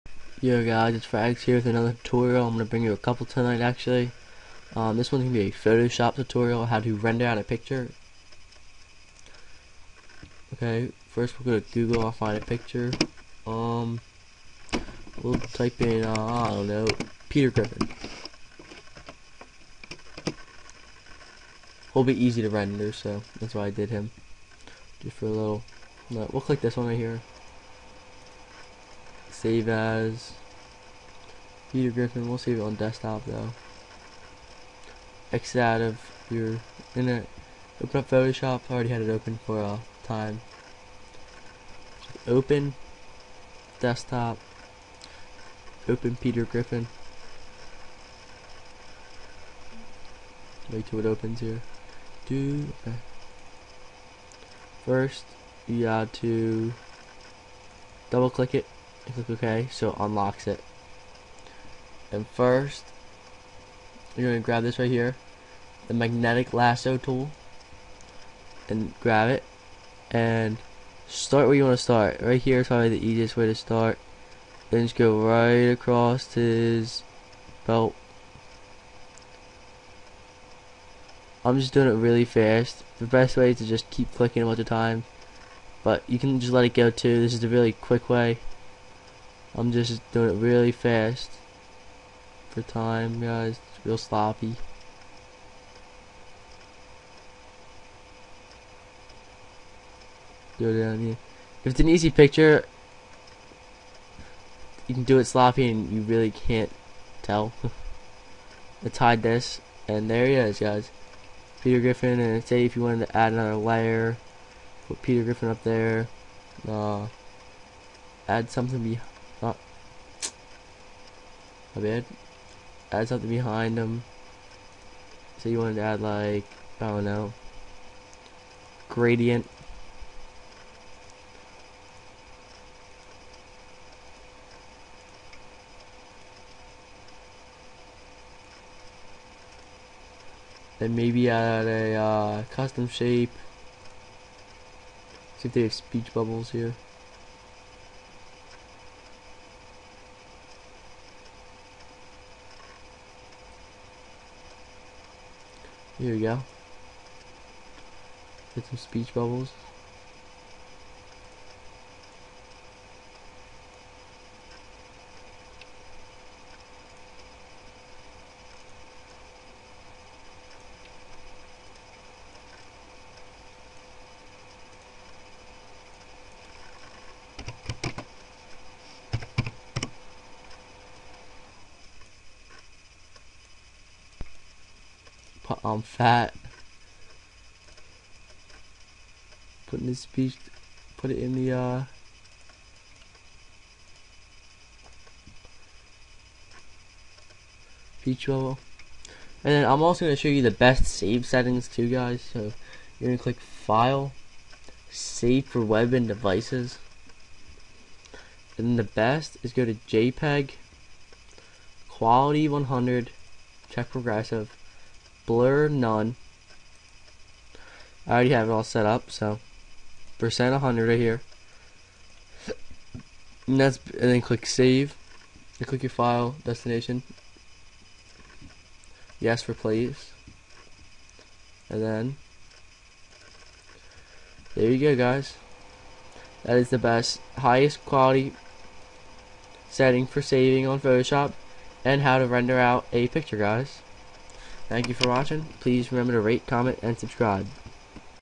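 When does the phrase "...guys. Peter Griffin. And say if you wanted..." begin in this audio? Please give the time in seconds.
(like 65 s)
110 s.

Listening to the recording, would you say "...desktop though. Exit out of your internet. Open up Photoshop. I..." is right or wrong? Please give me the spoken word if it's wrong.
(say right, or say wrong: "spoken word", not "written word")
right.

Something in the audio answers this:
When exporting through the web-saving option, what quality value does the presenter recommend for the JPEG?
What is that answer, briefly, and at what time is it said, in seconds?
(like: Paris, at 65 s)
100, at 211 s.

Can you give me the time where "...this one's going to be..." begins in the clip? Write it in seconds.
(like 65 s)
4 s.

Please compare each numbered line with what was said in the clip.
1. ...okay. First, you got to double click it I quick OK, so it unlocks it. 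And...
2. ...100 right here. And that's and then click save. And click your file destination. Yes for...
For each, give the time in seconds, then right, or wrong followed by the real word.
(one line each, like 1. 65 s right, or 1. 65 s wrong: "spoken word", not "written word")
1. 52 s wrong: "click", not "quick"
2. 220 s right.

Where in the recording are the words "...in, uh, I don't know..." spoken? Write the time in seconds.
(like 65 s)
15 s.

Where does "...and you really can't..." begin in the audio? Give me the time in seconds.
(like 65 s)
105 s.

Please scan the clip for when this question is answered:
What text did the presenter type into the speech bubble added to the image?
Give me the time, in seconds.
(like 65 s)
185 s.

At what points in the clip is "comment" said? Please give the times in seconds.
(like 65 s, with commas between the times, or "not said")
246 s.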